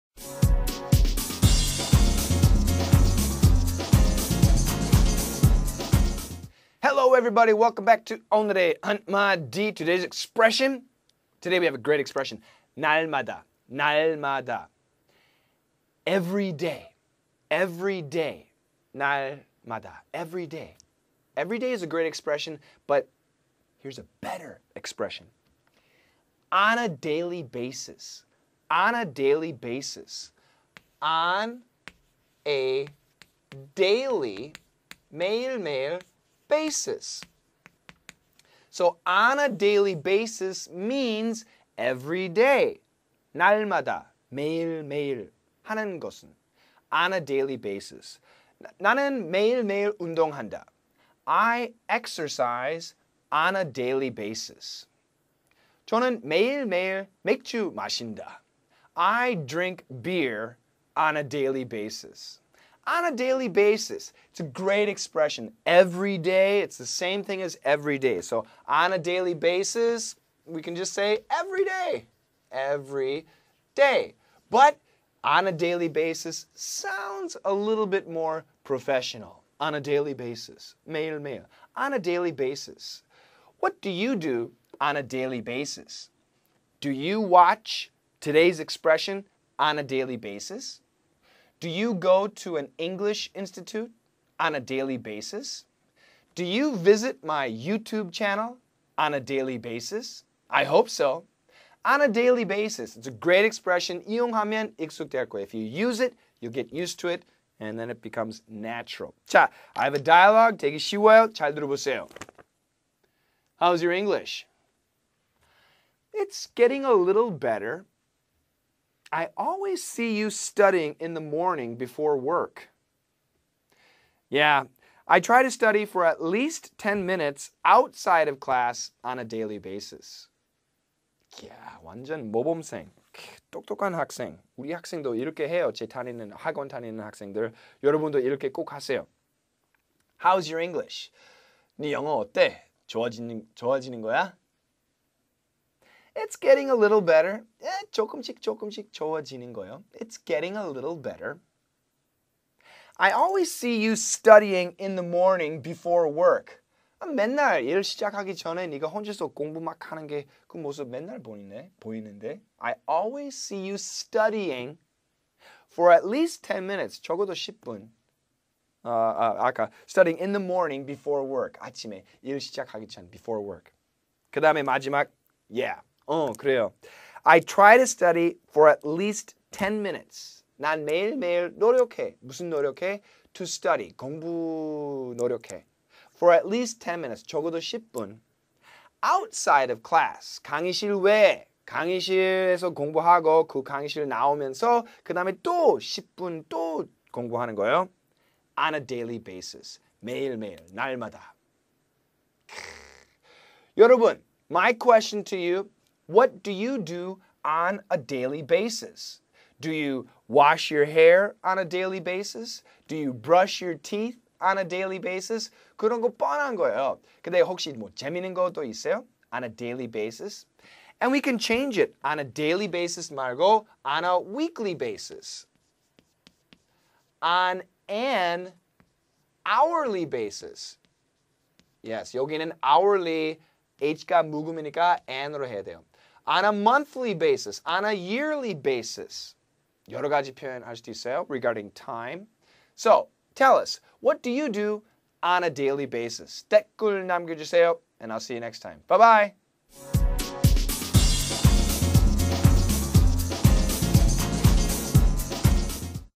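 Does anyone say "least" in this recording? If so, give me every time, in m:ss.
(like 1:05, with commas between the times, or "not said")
2:06, 2:46, 2:58, 3:06.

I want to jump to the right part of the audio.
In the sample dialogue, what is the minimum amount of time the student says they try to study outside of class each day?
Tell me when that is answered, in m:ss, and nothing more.
2:06.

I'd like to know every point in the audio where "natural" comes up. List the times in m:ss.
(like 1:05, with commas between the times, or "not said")
1:48.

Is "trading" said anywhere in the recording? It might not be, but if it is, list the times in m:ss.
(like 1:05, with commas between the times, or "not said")
not said.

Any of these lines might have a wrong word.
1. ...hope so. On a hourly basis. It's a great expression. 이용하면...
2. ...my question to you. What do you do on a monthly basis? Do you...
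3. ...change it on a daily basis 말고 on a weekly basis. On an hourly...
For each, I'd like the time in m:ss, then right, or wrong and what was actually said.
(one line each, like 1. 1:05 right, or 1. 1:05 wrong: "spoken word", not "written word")
1. 1:40 wrong: "daily", not "hourly"
2. 3:24 wrong: "daily", not "monthly"
3. 3:41 right.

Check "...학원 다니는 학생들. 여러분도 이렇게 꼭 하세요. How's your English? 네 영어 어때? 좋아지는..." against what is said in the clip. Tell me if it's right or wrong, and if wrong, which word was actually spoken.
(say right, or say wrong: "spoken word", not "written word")
right.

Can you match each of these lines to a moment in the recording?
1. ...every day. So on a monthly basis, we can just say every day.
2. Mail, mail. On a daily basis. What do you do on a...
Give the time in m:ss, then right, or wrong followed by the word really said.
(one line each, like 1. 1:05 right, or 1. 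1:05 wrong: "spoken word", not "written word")
1. 1:07 wrong: "daily", not "monthly"
2. 1:20 right.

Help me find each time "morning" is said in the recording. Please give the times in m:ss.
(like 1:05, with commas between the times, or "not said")
2:01, 2:35, 2:50.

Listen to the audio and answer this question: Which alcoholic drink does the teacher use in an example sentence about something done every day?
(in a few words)
beer.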